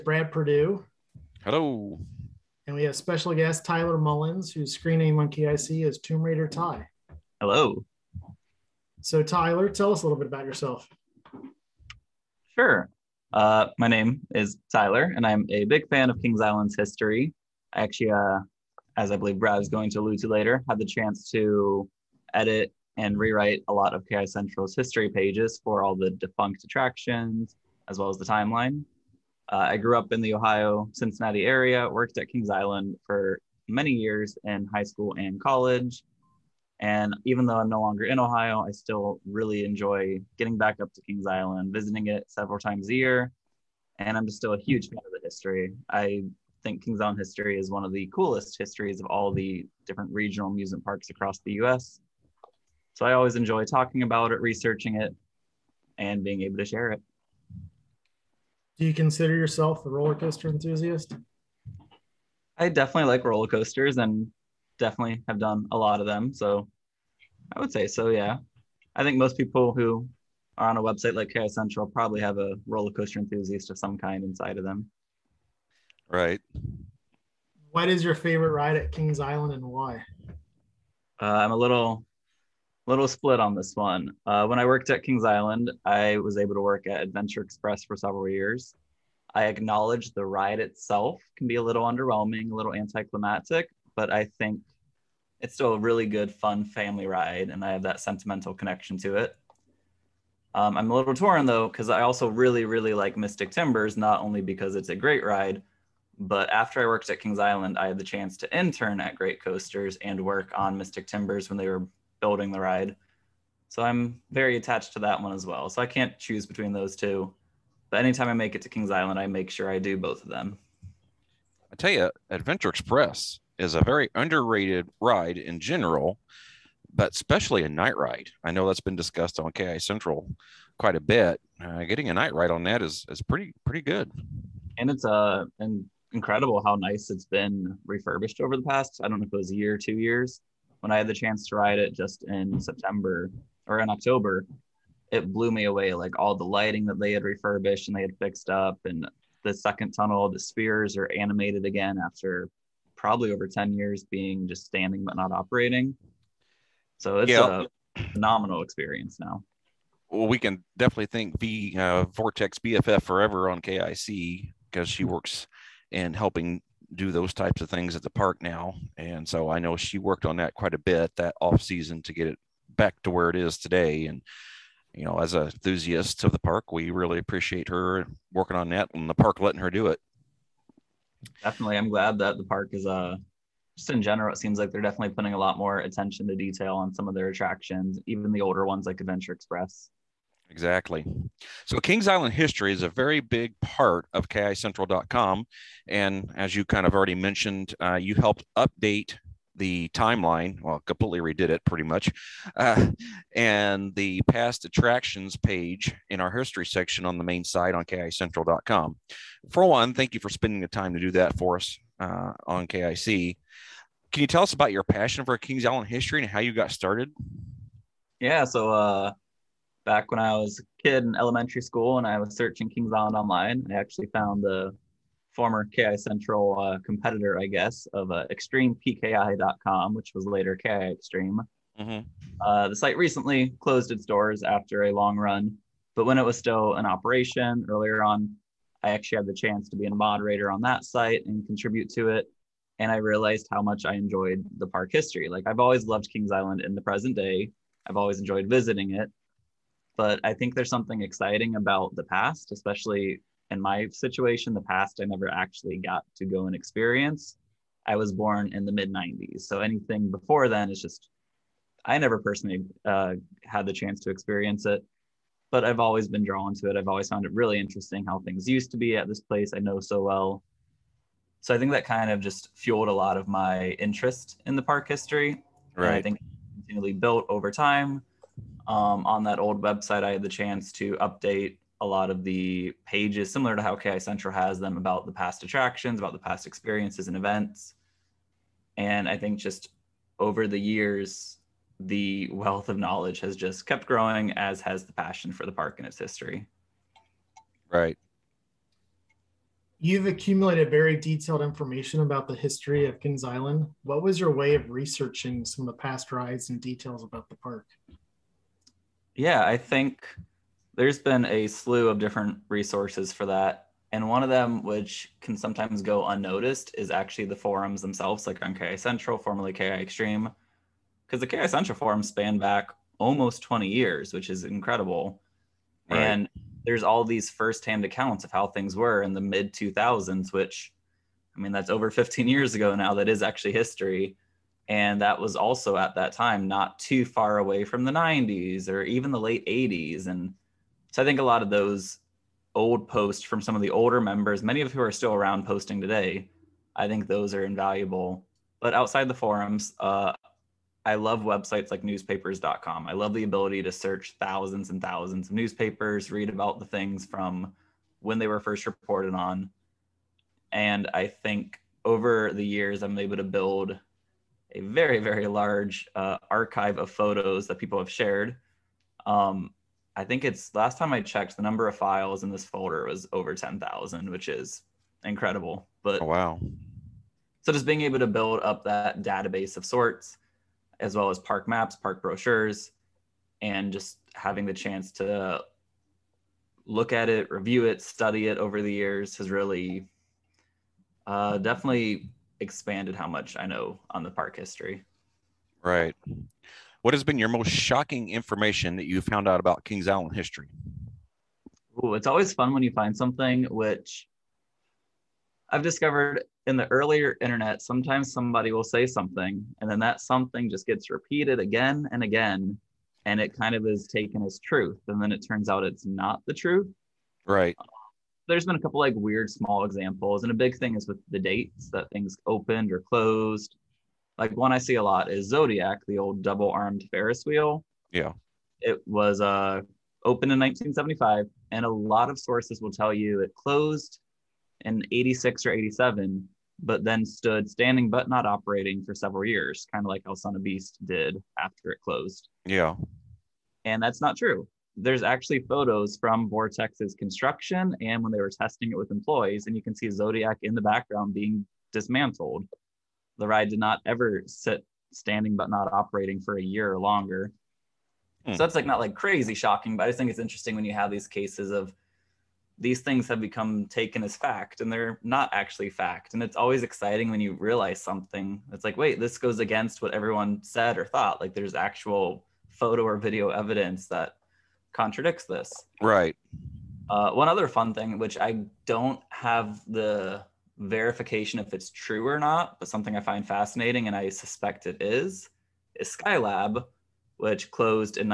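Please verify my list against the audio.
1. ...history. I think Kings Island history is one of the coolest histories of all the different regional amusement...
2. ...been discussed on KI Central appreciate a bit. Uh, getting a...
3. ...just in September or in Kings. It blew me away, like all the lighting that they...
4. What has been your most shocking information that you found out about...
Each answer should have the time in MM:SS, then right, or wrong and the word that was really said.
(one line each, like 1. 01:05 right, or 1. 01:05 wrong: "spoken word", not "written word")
1. 00:45 right
2. 02:08 wrong: "quite", not "appreciate"
3. 02:21 wrong: "October", not "Kings"
4. 06:36 right.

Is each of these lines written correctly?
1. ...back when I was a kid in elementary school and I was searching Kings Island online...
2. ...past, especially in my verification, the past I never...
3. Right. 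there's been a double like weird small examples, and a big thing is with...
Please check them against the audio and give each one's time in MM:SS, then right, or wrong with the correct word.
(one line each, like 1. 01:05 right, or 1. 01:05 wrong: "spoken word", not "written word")
1. 03:39 right
2. 04:12 wrong: "situation", not "verification"
3. 06:57 wrong: "couple", not "double".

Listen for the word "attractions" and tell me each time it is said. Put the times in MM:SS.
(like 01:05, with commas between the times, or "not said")
00:26, 03:07, 03:24, 04:45.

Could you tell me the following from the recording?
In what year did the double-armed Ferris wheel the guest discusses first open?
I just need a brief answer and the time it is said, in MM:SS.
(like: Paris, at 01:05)
1975, at 07:10.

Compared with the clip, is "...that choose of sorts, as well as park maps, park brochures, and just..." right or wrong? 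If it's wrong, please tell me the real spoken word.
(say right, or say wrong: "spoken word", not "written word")
wrong: "database", not "choose".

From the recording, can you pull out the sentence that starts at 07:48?
It's like, wait, this goes against what everyone said or thought.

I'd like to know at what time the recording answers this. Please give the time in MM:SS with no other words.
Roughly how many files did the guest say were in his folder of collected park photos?
06:13.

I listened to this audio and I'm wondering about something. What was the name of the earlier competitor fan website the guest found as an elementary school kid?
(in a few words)
extremepki.com.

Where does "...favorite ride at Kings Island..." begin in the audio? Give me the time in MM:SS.
01:18.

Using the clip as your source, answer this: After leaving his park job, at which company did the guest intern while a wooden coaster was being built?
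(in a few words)
Great Coasters.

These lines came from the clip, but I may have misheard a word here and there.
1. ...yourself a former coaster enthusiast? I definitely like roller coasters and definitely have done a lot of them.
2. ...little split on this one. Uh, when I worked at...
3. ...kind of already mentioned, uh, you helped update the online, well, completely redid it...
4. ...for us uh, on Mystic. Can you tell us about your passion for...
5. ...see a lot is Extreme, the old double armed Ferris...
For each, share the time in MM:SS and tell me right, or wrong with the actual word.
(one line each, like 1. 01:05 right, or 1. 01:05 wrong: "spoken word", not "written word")
1. 00:59 wrong: "roller", not "former"
2. 01:22 right
3. 03:16 wrong: "timeline", not "online"
4. 03:31 wrong: "KIC", not "Mystic"
5. 07:04 wrong: "Zodiac", not "Extreme".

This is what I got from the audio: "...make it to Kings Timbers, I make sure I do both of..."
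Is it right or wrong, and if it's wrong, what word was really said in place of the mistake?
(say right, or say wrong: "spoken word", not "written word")
wrong: "Island", not "Timbers".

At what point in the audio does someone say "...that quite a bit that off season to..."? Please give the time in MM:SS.
02:50.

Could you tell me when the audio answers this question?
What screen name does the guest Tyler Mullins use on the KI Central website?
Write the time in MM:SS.
00:05.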